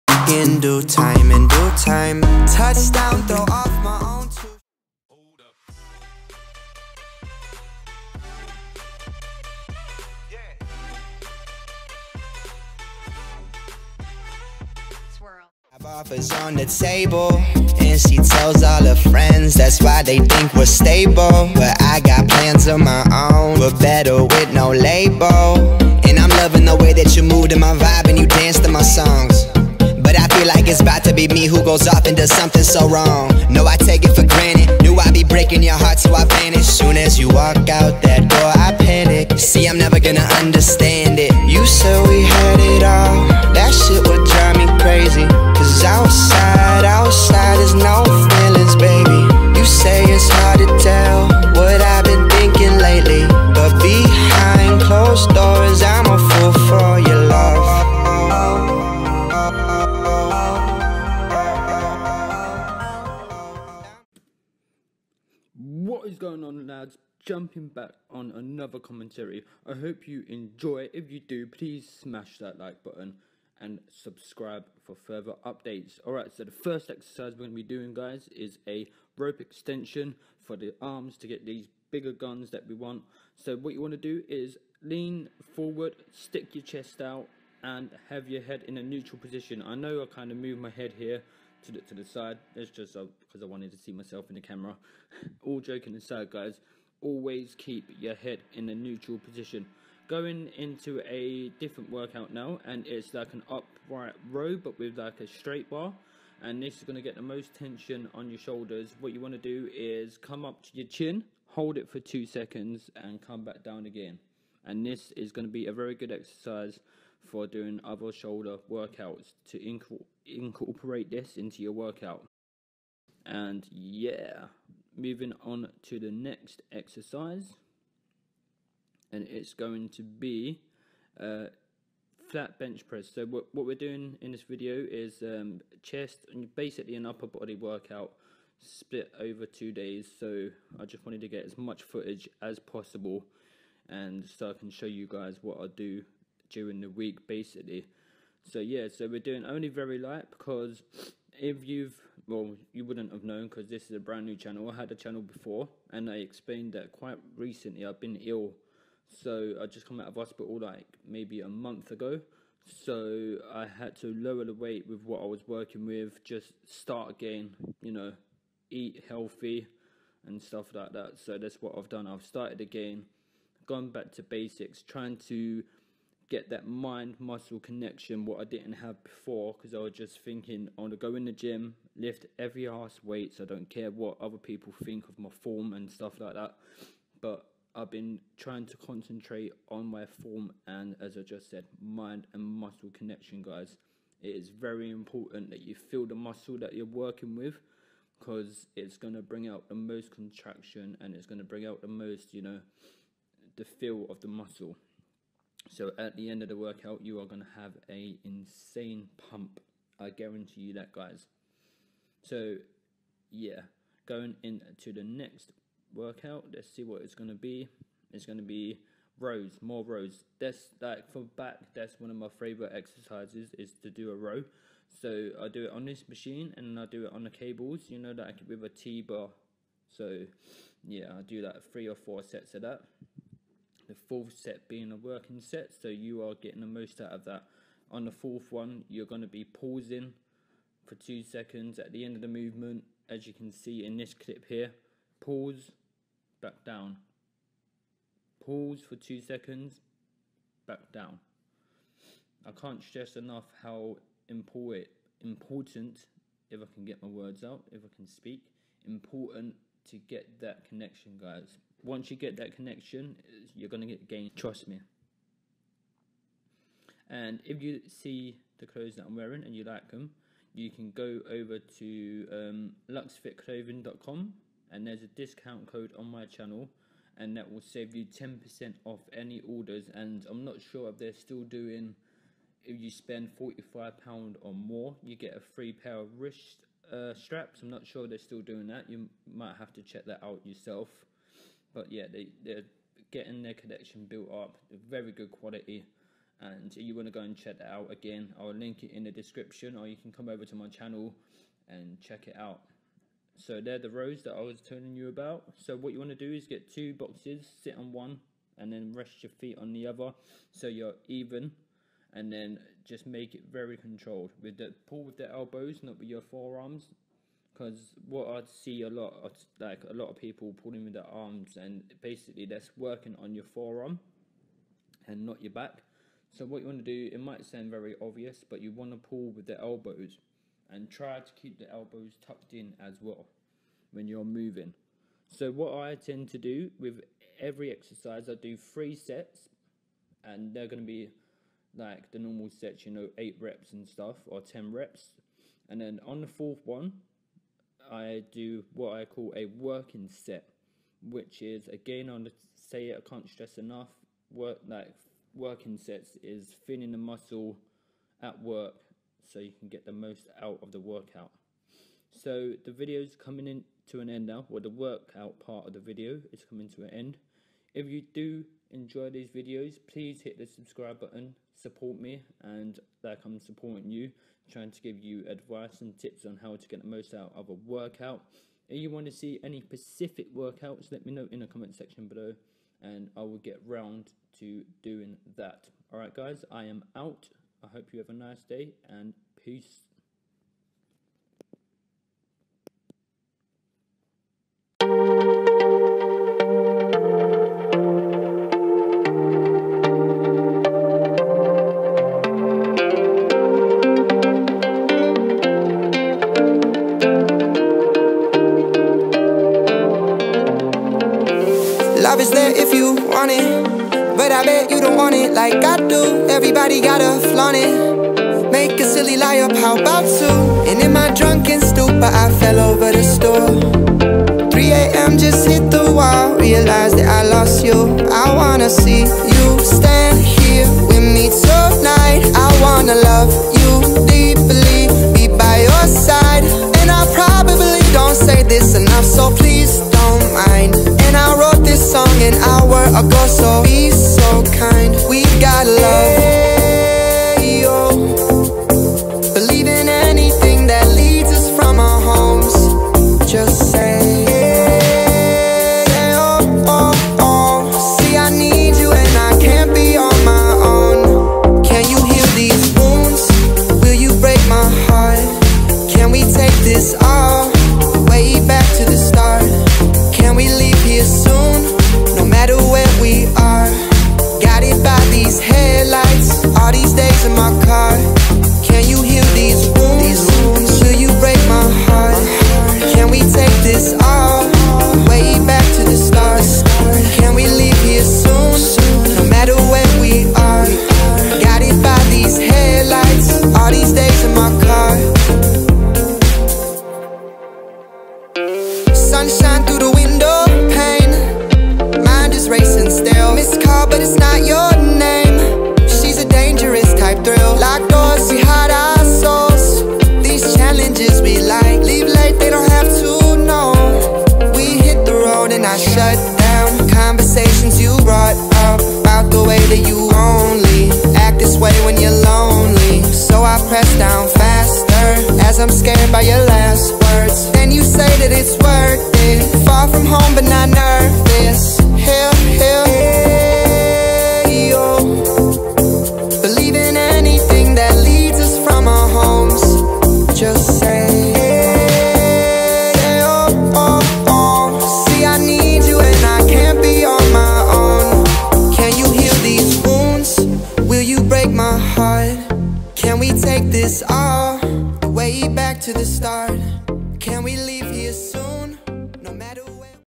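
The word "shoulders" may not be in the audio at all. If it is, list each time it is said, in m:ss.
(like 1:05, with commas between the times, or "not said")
1:48, 1:58.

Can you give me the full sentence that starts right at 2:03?
And yeah, moving on to the next exercise.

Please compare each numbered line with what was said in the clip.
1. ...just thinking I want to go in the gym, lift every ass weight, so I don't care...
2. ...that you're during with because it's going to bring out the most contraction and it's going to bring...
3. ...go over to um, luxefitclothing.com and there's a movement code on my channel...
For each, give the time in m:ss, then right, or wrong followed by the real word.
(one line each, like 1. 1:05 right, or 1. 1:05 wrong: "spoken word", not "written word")
1. 2:59 right
2. 3:16 wrong: "working", not "during"
3. 4:30 wrong: "discount", not "movement".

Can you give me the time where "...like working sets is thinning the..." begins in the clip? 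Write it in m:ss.
5:54.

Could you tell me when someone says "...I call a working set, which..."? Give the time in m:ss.
5:48.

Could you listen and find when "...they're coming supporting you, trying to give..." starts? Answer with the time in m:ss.
6:13.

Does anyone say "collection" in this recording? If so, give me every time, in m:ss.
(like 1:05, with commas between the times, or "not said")
4:53.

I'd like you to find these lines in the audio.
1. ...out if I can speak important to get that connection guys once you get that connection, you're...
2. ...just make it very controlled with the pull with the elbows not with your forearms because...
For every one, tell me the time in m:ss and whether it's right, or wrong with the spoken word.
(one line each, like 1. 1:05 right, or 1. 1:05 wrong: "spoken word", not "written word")
1. 4:17 right
2. 5:12 right.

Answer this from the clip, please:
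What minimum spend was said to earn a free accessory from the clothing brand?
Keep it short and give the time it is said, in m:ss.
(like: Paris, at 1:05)
£45, at 4:43.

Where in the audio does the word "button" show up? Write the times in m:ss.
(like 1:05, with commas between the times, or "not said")
1:12, 6:10.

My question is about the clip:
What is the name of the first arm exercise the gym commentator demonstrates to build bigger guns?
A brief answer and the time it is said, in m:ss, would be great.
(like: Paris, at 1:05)
rope extension, at 1:19.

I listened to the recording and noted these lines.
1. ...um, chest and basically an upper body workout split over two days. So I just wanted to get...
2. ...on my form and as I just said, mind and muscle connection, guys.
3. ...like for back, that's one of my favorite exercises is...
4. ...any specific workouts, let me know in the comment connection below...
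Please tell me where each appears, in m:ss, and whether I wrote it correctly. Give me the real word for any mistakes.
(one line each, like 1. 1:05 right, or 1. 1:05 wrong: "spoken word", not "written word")
1. 2:15 right
2. 3:09 right
3. 3:40 right
4. 6:19 wrong: "section", not "connection".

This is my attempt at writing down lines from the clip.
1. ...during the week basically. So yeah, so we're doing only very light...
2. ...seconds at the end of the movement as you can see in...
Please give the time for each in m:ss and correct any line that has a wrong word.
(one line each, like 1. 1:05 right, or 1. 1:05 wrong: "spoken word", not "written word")
1. 2:26 right
2. 4:01 right.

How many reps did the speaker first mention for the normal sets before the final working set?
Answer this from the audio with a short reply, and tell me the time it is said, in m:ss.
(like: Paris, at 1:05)
8, at 5:43.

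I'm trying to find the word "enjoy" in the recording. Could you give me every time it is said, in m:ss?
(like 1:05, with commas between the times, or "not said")
1:10, 6:08.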